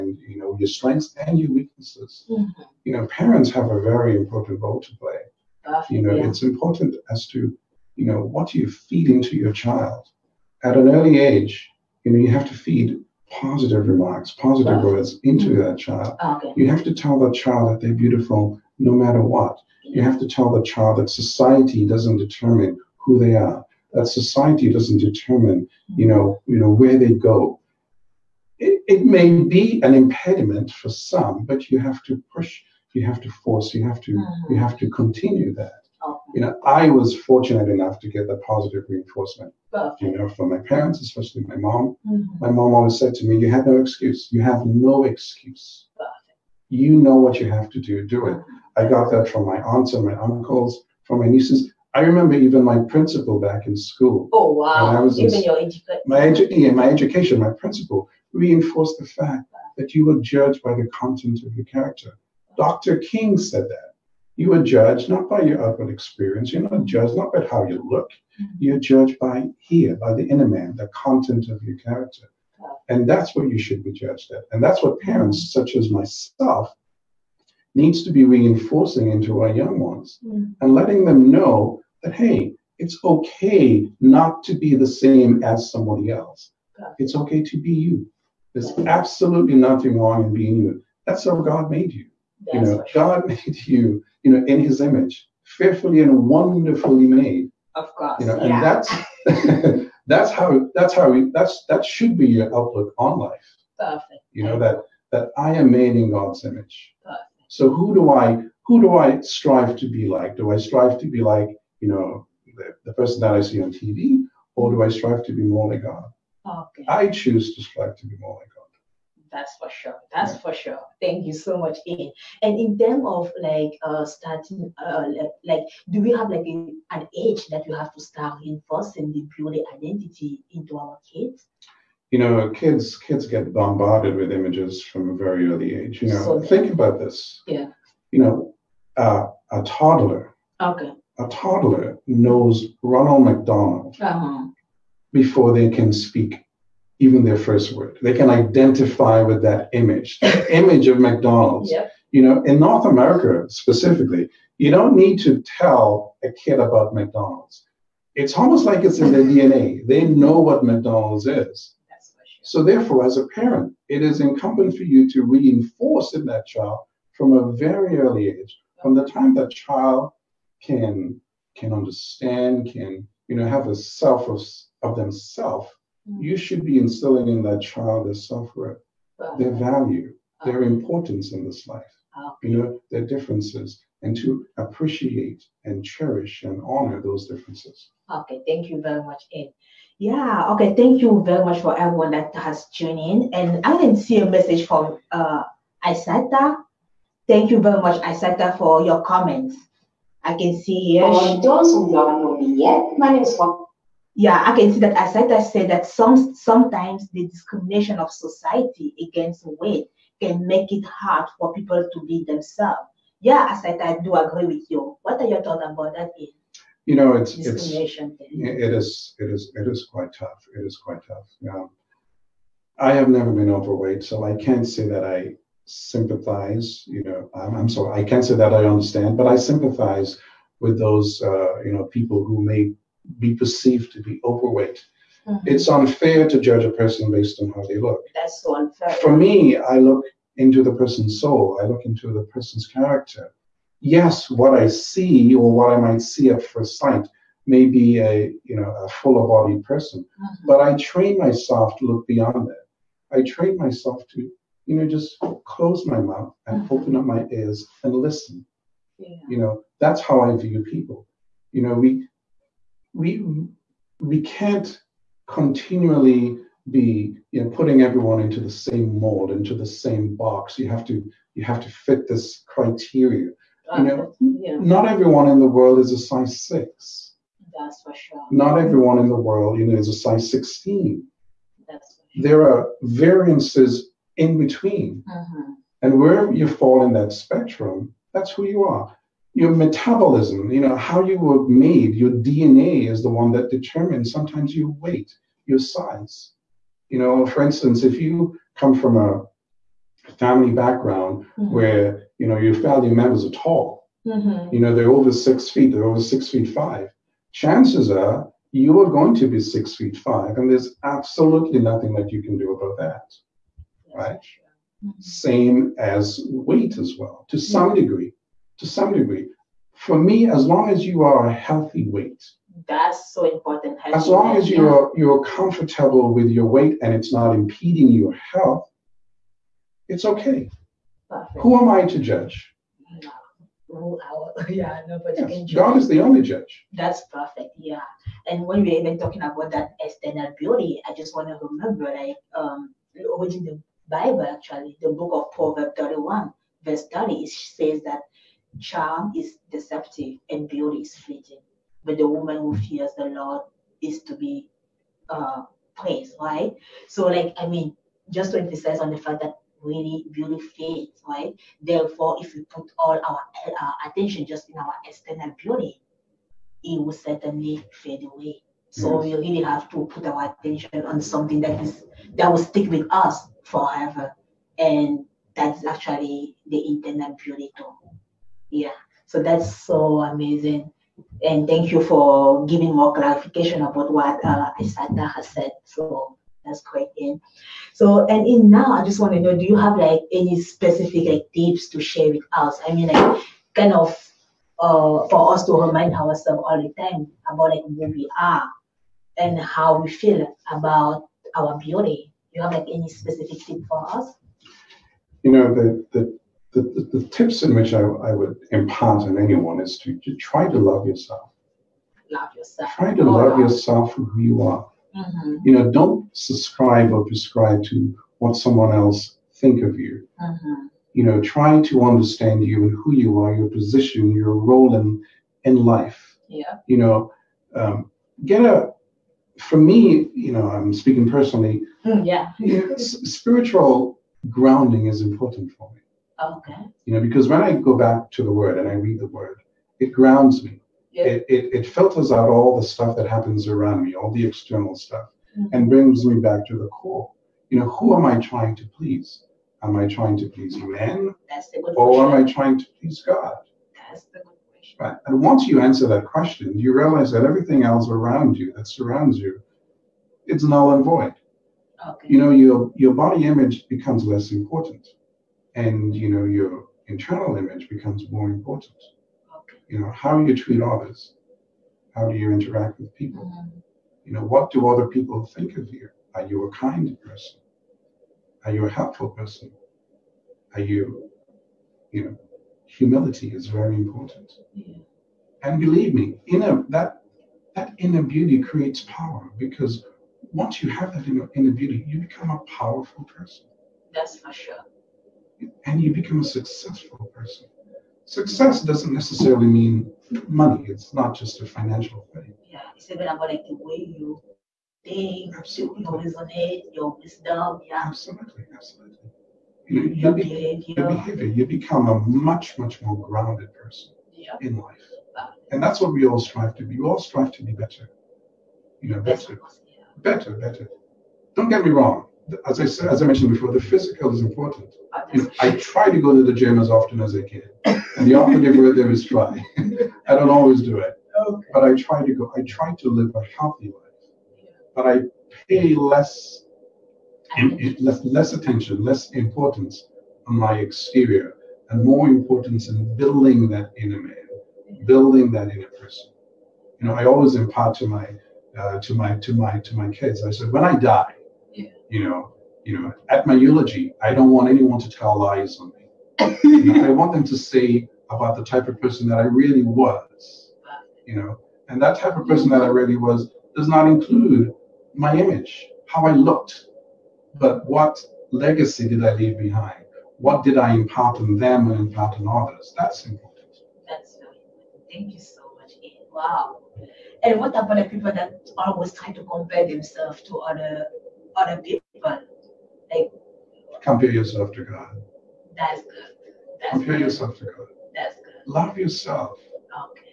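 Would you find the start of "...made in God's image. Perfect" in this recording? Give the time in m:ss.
1:45.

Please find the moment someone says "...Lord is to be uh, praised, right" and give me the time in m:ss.
5:53.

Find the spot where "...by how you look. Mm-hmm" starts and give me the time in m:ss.
1:07.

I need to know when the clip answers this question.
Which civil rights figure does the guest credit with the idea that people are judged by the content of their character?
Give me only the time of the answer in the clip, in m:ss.
1:02.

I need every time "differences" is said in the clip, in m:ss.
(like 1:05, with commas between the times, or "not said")
3:03, 3:07.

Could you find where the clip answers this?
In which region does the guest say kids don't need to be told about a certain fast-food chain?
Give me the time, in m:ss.
2:32.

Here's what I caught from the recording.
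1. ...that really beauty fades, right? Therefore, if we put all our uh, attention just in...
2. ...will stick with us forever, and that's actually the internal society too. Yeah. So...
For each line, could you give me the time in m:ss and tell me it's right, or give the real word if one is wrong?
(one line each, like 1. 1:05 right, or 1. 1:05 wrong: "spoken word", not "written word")
1. 5:59 right
2. 6:12 wrong: "beauty", not "society".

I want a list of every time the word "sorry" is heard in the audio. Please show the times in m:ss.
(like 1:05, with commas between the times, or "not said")
3:47.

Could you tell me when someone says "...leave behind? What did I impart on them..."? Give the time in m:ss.
9:29.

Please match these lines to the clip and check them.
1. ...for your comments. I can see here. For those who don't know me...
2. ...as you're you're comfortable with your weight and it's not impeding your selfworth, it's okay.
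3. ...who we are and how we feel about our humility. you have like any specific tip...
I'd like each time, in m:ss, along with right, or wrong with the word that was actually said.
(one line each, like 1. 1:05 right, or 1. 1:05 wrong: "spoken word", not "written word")
1. 3:18 right
2. 5:24 wrong: "health", not "selfworth"
3. 6:37 wrong: "beauty", not "humility".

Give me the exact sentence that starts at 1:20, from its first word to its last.
and letting them know that, hey, it's okay not to be the same as somebody else.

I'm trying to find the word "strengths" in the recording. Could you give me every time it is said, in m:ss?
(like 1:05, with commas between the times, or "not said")
0:00.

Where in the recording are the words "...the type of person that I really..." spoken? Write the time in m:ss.
9:18.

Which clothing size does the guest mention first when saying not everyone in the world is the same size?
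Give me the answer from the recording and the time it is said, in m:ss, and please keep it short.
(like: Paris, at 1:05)
size 6, at 4:35.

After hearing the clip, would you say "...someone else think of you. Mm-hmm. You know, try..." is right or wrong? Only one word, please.
right.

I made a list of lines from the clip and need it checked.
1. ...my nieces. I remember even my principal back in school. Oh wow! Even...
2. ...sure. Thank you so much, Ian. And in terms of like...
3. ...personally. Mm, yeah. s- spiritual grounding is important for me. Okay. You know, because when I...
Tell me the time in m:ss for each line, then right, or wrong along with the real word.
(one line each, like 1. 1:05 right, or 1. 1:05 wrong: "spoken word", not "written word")
1. 0:51 right
2. 2:00 right
3. 7:11 right.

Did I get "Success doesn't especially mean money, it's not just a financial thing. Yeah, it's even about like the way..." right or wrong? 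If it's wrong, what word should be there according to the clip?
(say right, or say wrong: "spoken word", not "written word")
wrong: "necessarily", not "especially".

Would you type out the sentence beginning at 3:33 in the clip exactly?
Yeah, as I do agree with you.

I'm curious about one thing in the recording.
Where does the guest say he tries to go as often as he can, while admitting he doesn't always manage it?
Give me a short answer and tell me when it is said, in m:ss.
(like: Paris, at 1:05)
the gym, at 8:46.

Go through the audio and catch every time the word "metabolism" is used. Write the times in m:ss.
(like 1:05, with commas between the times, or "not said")
4:49.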